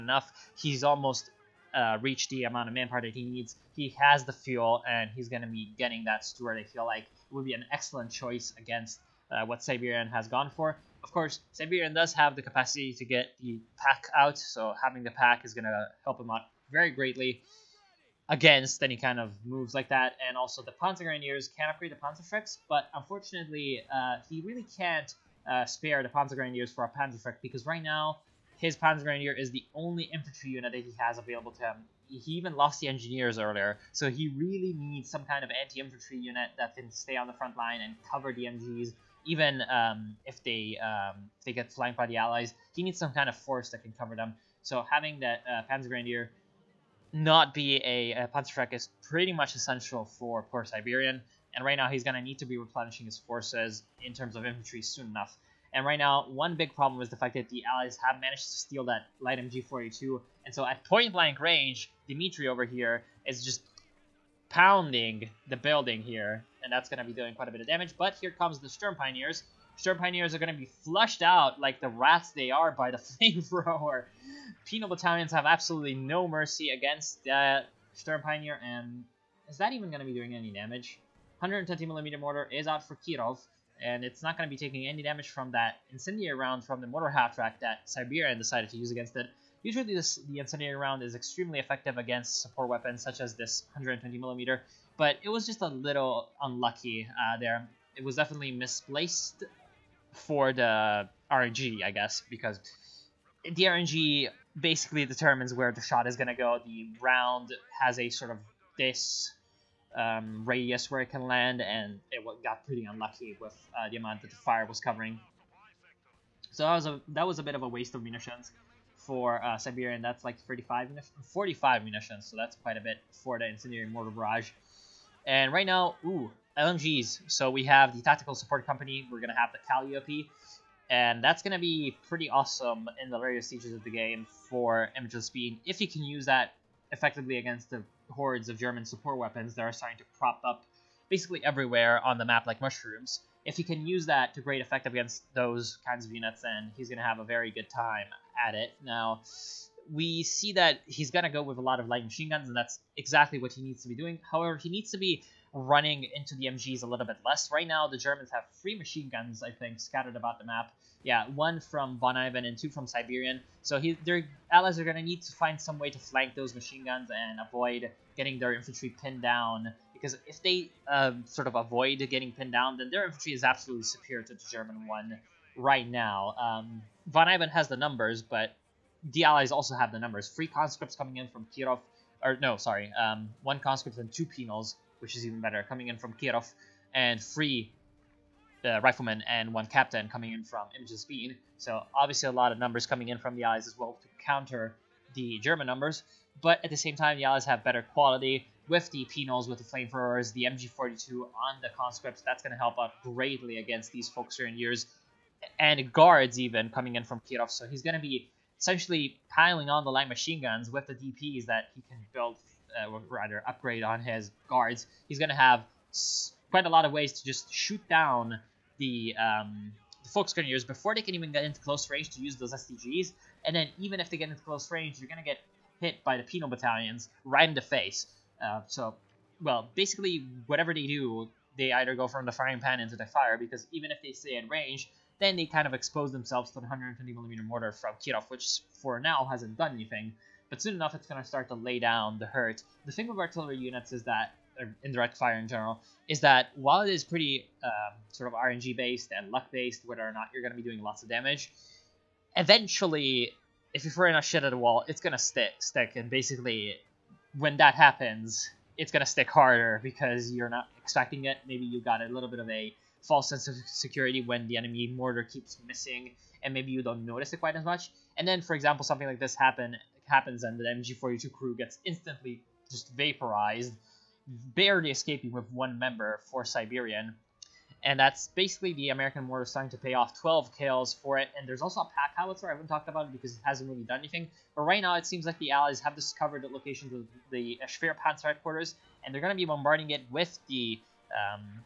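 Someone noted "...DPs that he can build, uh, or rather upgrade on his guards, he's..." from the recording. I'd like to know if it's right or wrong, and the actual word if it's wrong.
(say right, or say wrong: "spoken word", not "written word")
right.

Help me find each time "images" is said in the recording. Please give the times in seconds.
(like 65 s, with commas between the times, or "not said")
134 s, 190 s.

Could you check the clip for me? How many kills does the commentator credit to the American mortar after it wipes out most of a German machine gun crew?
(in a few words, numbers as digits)
12.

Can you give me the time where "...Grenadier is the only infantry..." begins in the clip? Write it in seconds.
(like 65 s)
29 s.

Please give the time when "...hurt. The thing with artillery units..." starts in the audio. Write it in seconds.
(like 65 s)
242 s.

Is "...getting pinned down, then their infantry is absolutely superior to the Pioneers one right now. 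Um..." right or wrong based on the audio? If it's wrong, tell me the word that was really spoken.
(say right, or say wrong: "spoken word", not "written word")
wrong: "German", not "Pioneers".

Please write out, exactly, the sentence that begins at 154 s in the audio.
However, he needs to be running into the MGs a little bit less.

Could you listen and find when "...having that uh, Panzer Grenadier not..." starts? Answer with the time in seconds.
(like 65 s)
44 s.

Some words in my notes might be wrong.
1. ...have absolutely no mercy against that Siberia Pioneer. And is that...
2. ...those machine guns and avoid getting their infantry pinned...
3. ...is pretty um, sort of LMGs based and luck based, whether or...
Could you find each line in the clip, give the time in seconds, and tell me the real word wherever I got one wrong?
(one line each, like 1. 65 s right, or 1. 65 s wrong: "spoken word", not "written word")
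1. 75 s wrong: "Sturm", not "Siberia"
2. 166 s right
3. 246 s wrong: "RNG", not "LMGs".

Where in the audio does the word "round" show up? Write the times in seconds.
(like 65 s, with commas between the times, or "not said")
86 s, 90 s, 107 s.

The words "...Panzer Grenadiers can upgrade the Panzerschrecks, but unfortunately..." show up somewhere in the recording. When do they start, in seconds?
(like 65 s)
20 s.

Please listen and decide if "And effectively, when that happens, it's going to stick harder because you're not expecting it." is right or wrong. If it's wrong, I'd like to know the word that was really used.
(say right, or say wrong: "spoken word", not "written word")
wrong: "basically", not "effectively".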